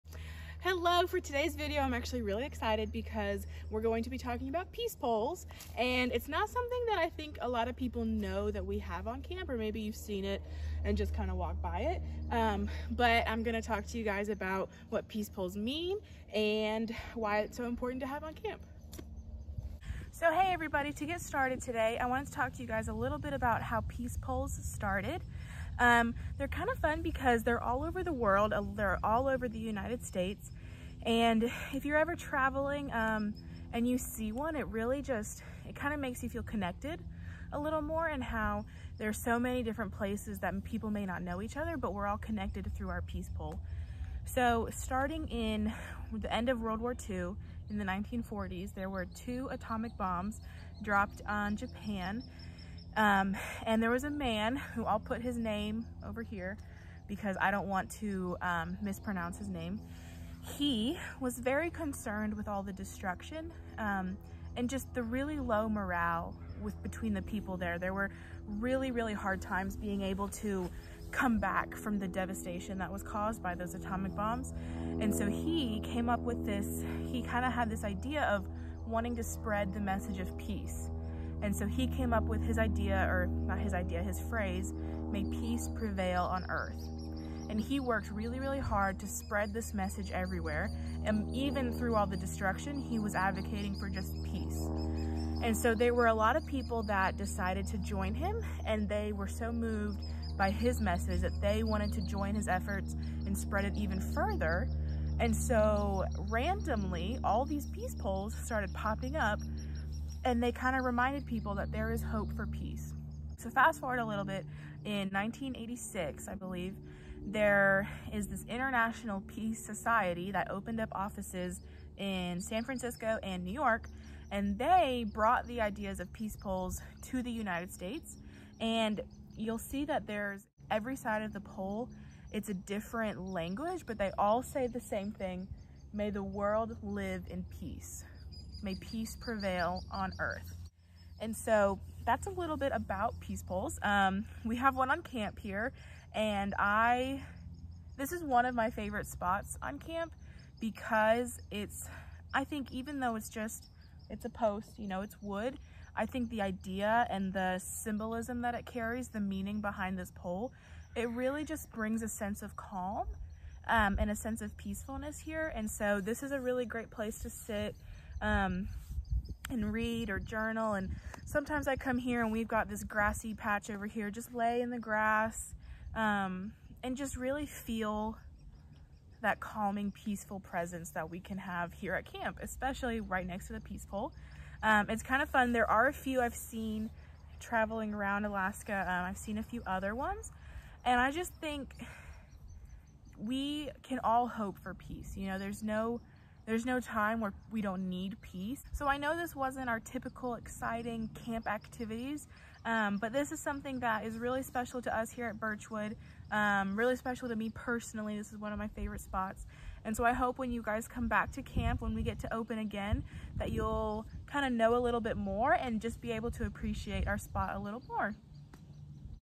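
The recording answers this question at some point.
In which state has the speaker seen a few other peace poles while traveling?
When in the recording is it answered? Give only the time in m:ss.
3:08.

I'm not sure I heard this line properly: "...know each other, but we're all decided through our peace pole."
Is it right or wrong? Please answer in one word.
wrong.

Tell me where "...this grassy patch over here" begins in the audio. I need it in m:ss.
2:52.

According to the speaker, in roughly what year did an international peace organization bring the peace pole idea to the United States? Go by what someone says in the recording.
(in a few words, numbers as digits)
1986.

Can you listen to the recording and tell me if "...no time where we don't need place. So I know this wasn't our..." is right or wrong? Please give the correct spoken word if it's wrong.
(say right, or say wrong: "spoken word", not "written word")
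wrong: "peace", not "place".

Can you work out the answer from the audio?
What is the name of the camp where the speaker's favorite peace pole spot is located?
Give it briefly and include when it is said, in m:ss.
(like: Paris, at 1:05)
Birchwood, at 3:25.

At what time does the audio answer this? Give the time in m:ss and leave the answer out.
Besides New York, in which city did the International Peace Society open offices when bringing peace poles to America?
2:02.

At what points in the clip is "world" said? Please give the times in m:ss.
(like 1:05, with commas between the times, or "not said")
0:28, 0:46, 2:16.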